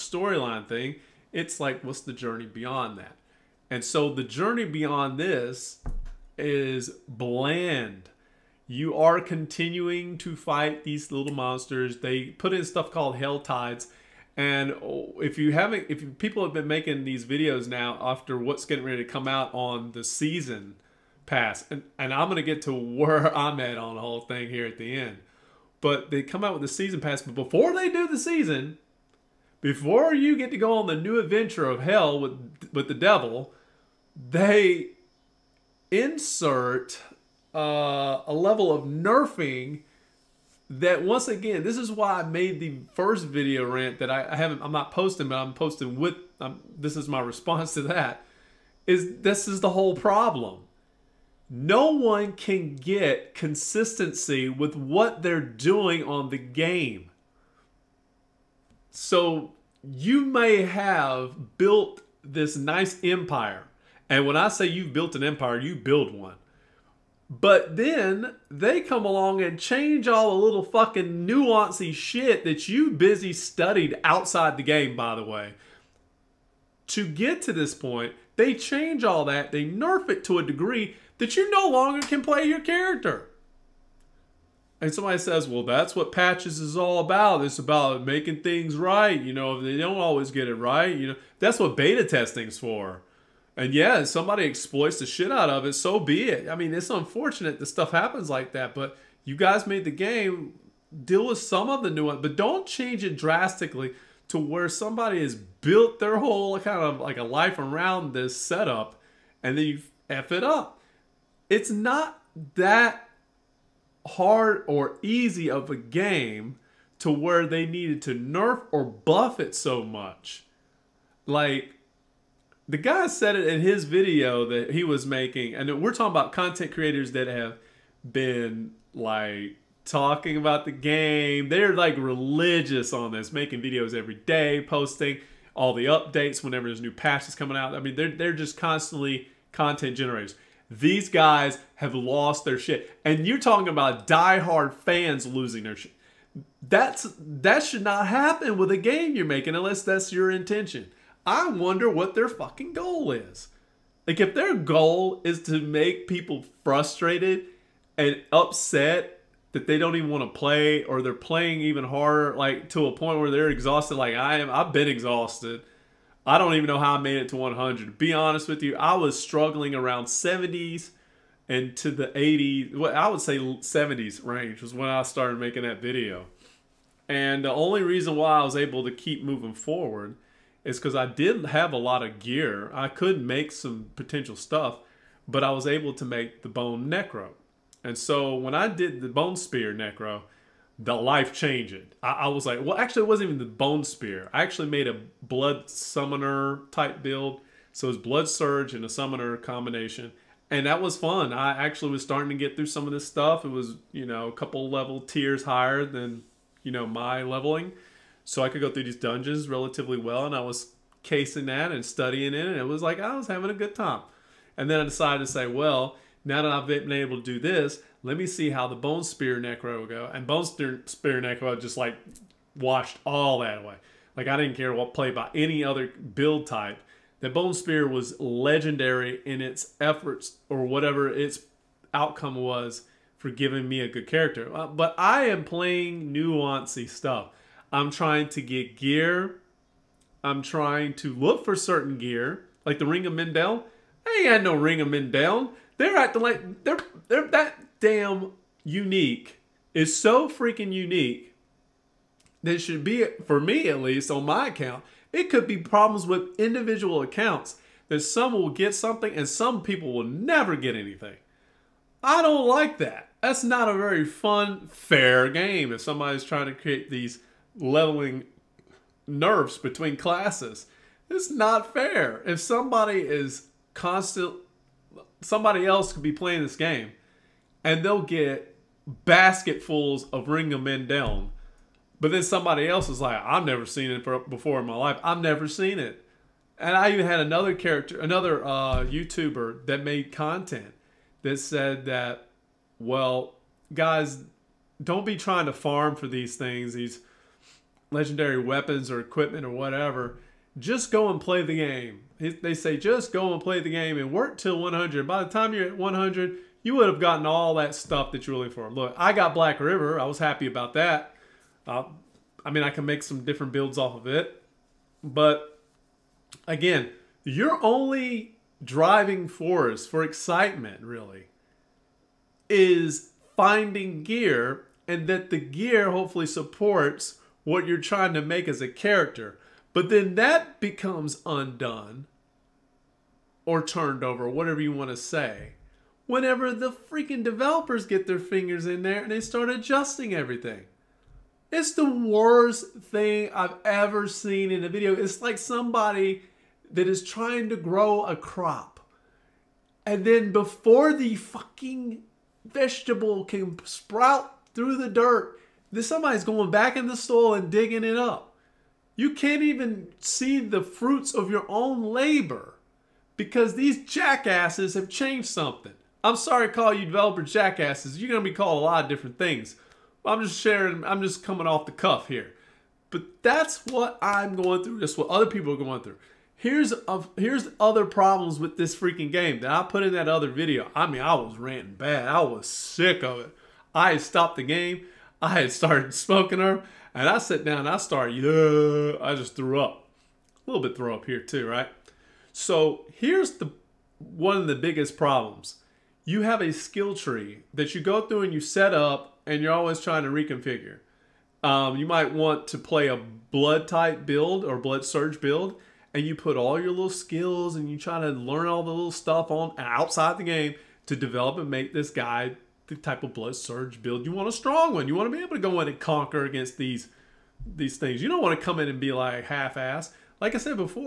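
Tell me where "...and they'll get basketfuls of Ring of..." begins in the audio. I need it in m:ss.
4:37.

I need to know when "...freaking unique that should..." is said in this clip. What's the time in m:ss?
4:10.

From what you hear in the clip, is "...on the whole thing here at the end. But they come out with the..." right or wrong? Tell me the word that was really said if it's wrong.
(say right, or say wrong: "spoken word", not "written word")
right.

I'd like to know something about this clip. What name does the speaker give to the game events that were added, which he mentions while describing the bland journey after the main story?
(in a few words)
Helltides.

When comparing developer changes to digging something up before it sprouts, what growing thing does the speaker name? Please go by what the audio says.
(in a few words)
A crop.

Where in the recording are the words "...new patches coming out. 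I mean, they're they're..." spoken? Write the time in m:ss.
2:16.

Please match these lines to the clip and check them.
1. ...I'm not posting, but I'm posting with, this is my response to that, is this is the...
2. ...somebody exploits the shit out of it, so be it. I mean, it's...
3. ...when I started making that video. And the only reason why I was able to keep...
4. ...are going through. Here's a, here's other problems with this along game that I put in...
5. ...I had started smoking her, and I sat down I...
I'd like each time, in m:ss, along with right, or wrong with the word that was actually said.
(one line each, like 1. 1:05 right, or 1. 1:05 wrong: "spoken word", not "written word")
1. 0:44 right
2. 1:34 right
3. 2:54 right
4. 6:15 wrong: "freaking", not "along"
5. 6:25 right.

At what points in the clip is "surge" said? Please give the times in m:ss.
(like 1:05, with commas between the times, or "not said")
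3:18, 6:44, 6:53.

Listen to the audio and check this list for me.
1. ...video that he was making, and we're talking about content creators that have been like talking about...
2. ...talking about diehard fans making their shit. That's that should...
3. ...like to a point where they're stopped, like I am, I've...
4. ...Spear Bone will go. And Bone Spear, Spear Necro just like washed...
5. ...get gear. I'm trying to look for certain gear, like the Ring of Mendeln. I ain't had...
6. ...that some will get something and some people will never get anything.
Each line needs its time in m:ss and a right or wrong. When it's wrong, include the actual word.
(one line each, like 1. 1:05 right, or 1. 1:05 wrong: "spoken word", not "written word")
1. 2:03 right
2. 2:23 wrong: "losing", not "making"
3. 2:42 wrong: "exhausted", not "stopped"
4. 3:39 wrong: "Necro", not "Bone"
5. 3:58 right
6. 4:17 right.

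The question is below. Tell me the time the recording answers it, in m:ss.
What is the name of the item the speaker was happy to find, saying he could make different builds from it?
5:09.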